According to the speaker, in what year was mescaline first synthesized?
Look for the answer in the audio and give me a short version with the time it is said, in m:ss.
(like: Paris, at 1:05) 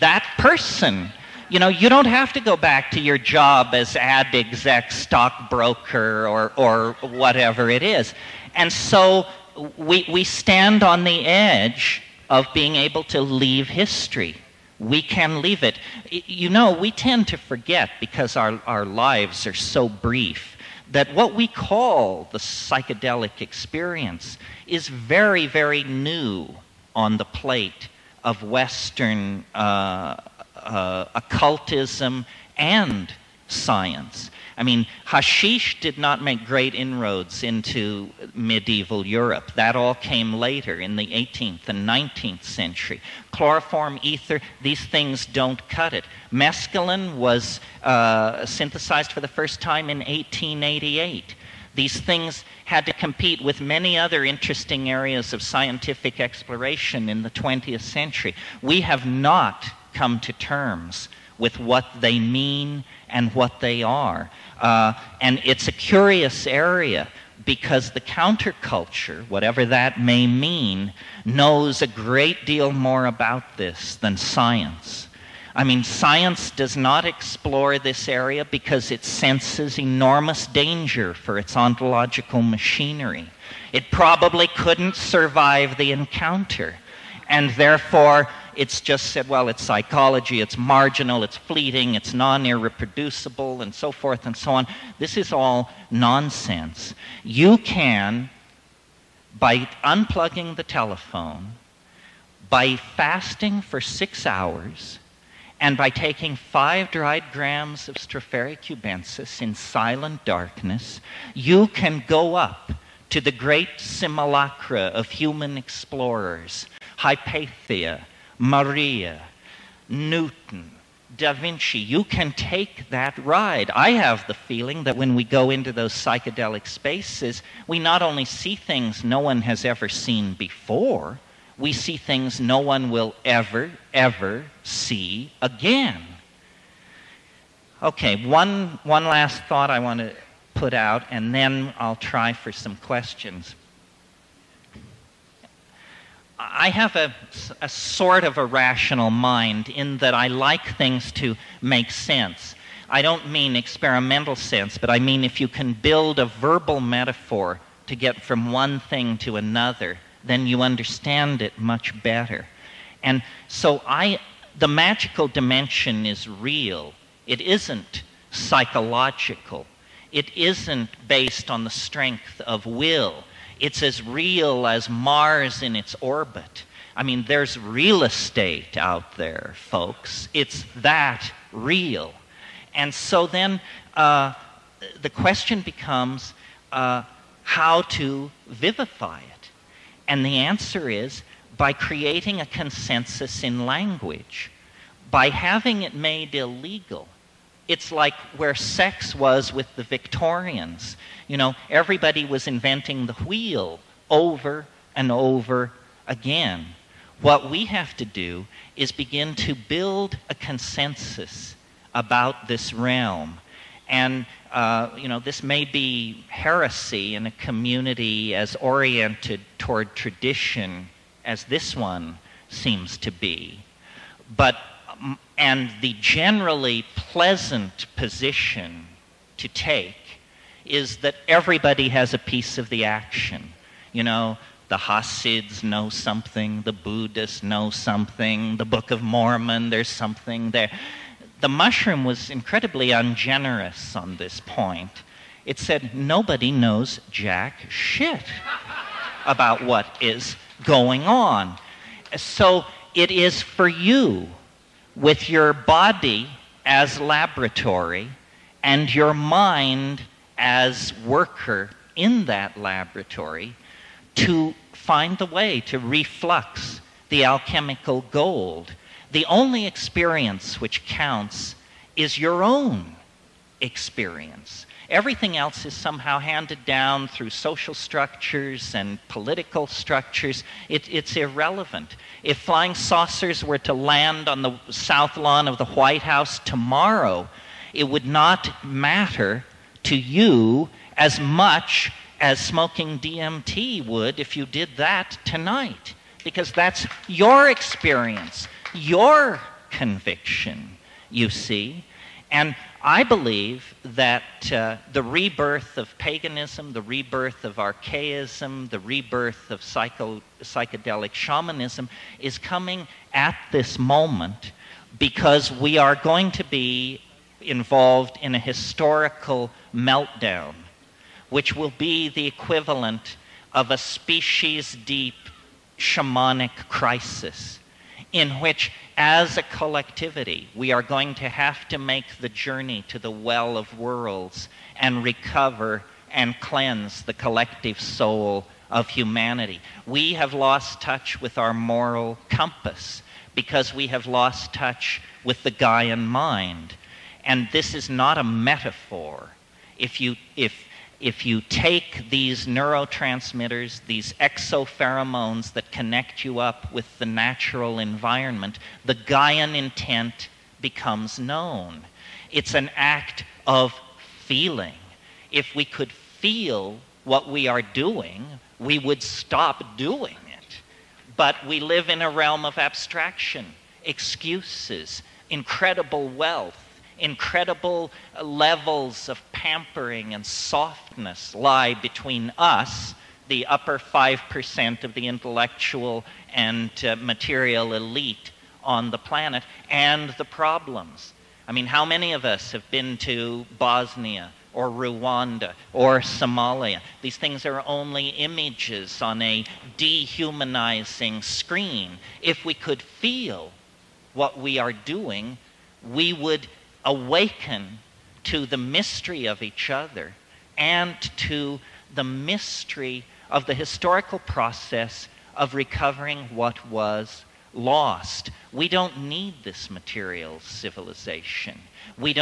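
1888, at 0:49.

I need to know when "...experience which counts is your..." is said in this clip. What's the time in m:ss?
4:29.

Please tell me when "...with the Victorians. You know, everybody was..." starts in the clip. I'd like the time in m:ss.
3:19.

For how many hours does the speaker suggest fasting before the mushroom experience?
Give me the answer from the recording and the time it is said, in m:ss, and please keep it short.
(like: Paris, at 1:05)
6, at 1:43.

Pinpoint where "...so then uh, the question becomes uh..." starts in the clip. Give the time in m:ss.
3:02.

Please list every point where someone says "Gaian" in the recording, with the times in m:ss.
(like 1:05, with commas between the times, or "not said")
5:45, 5:58.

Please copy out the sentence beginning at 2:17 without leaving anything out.
Okay, one, one last thought I want to put out, and then I'll try for some questions.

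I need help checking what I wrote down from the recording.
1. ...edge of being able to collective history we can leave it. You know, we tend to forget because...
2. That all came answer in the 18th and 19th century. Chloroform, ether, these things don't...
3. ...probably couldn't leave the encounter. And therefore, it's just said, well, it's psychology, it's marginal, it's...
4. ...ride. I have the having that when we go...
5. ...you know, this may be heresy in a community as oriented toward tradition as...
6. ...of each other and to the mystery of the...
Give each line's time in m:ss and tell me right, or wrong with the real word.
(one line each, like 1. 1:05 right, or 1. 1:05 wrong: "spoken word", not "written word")
1. 0:11 wrong: "leave", not "collective"
2. 0:39 wrong: "later", not "answer"
3. 1:23 wrong: "survive", not "leave"
4. 2:03 wrong: "feeling", not "having"
5. 3:34 right
6. 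6:49 right.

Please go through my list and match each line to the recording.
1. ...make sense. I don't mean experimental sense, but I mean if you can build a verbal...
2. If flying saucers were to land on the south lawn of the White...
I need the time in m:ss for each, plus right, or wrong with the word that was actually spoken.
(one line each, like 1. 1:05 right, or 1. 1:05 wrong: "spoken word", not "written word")
1. 2:31 right
2. 4:42 right.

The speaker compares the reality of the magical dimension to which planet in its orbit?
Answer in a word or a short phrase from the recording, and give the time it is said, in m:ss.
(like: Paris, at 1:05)
Mars, at 2:54.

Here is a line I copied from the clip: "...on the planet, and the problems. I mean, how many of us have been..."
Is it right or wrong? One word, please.
right.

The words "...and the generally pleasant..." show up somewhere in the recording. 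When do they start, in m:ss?
3:45.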